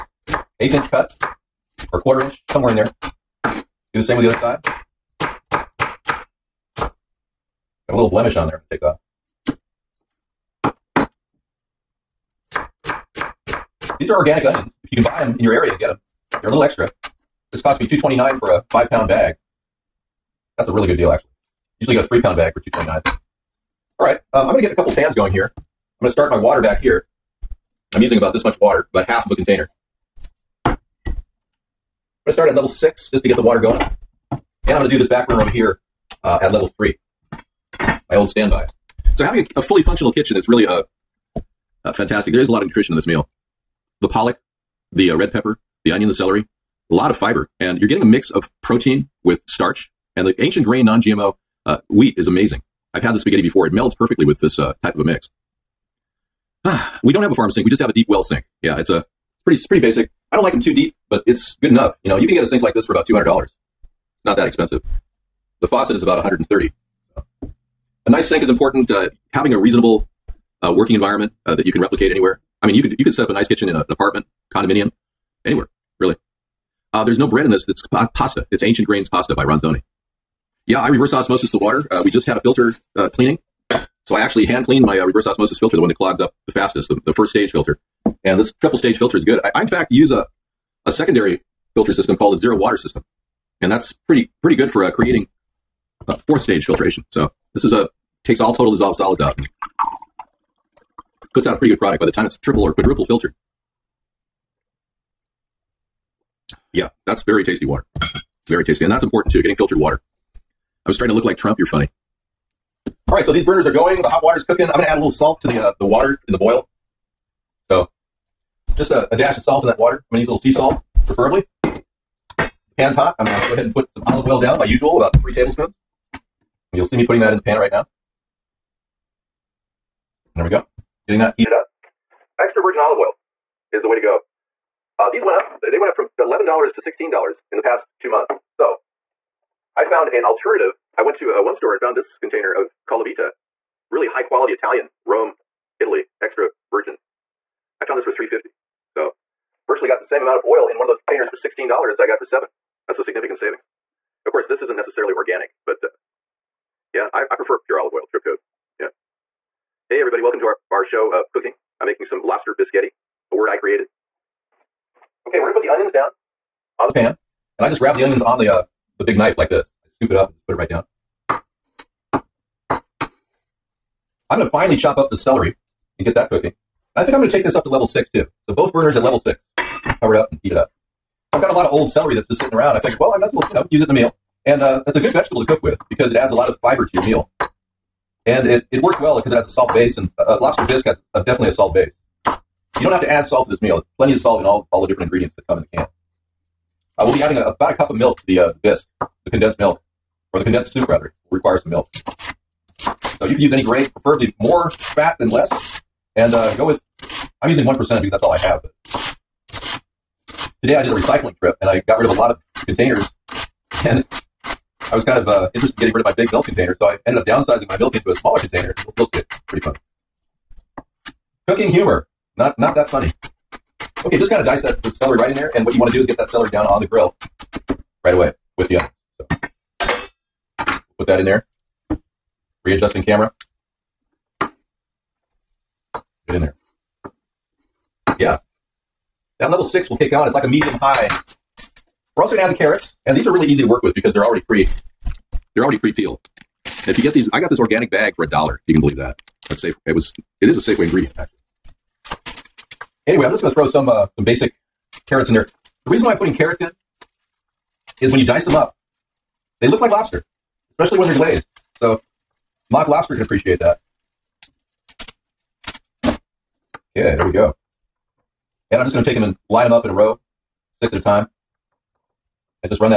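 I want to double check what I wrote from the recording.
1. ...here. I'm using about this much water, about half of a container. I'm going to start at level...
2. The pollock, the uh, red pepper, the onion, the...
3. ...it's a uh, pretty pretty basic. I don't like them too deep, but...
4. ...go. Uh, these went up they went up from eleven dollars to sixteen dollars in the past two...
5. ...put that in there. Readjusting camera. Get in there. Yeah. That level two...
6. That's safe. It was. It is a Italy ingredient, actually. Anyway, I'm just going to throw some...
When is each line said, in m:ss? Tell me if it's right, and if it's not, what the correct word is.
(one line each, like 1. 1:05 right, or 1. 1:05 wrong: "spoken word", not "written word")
1. 0:26 right
2. 0:44 right
3. 0:58 right
4. 2:13 right
5. 3:50 wrong: "six", not "two"
6. 4:09 wrong: "Safeway", not "Italy".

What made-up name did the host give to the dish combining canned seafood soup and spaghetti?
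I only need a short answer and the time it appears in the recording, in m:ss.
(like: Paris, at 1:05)
Lobster Bisqghetti, at 2:42.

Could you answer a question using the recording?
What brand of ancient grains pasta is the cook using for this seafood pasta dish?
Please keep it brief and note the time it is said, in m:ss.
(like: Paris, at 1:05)
Ronzoni, at 1:19.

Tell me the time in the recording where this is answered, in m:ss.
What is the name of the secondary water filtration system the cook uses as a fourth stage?
1:32.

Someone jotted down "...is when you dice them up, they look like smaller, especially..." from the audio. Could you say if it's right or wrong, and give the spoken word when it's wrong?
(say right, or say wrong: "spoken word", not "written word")
wrong: "lobster", not "smaller".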